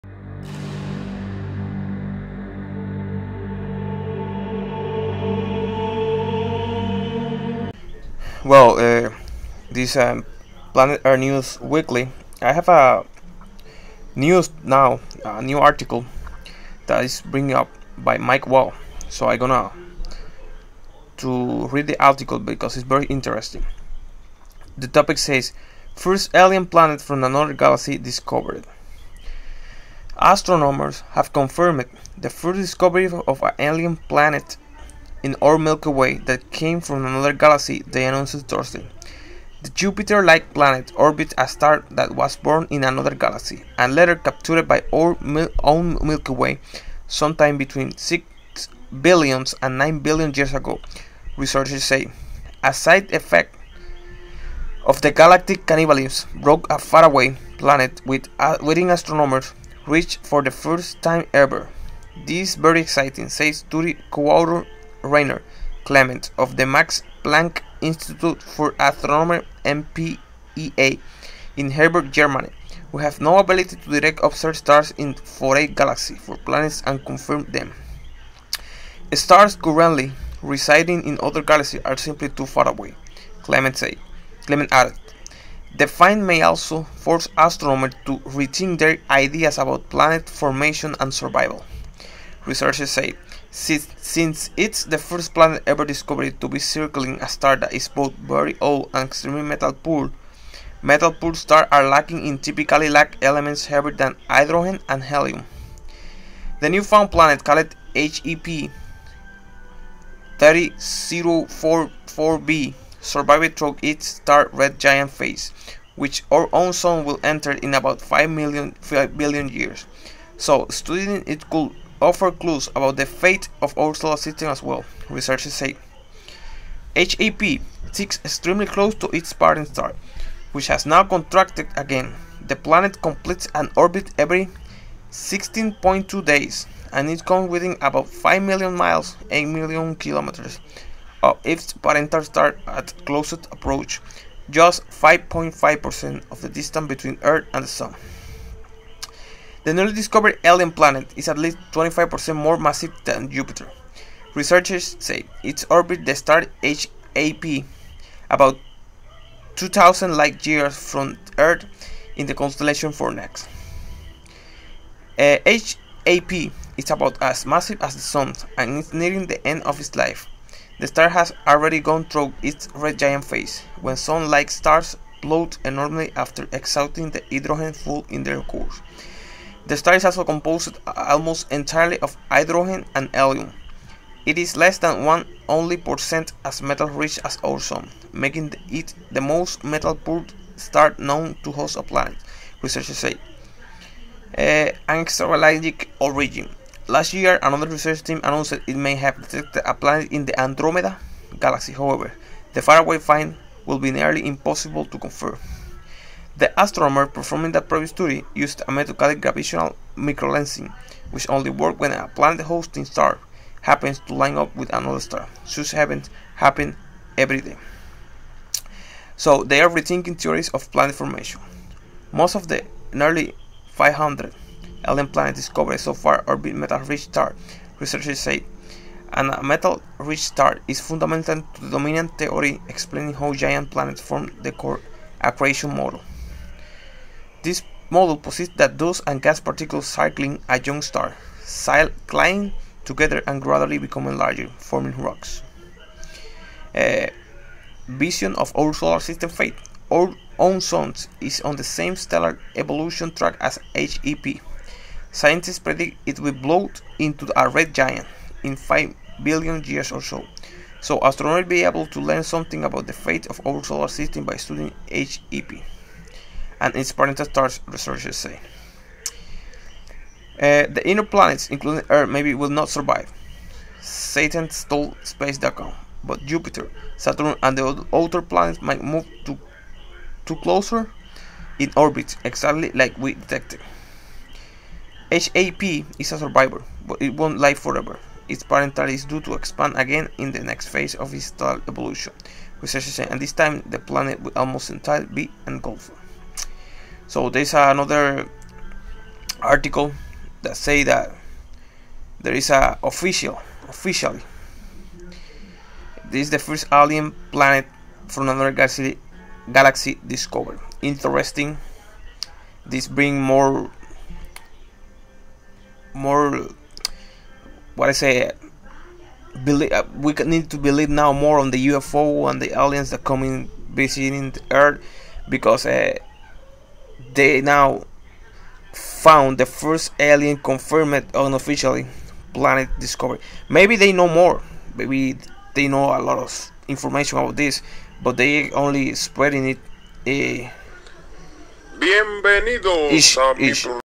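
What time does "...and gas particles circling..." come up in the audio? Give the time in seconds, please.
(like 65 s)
239 s.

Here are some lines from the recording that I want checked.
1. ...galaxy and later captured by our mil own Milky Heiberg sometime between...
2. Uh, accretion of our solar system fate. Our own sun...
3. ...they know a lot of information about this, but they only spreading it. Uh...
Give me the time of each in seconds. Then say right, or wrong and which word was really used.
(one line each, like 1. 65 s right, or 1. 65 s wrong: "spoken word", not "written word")
1. 43 s wrong: "Way", not "Heiberg"
2. 246 s wrong: "vision", not "accretion"
3. 335 s right.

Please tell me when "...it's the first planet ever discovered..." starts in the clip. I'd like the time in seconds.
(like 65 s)
94 s.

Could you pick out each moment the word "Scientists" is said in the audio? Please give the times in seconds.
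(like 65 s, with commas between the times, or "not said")
255 s.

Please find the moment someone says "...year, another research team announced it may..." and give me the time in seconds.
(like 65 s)
197 s.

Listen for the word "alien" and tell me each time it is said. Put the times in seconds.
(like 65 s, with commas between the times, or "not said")
26 s, 33 s, 150 s, 224 s, 306 s, 322 s, 329 s.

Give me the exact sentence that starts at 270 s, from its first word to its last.
Uh, the inner planets, including Earth, maybe will not survive.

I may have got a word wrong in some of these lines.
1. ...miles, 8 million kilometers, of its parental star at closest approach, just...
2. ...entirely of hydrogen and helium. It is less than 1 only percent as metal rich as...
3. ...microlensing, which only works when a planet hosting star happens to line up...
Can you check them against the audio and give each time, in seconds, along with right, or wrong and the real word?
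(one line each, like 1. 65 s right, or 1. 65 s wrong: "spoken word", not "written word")
1. 138 s right
2. 181 s right
3. 209 s right.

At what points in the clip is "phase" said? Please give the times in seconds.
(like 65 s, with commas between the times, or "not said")
115 s, 173 s, 290 s.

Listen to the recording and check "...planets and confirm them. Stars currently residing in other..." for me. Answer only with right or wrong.
right.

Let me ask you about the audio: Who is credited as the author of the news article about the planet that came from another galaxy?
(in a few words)
Mike Wall.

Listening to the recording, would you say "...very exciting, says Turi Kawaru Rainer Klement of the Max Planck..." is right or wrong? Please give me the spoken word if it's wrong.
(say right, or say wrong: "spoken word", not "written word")
right.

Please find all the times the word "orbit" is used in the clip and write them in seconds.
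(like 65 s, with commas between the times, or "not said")
40 s, 133 s, 155 s, 281 s.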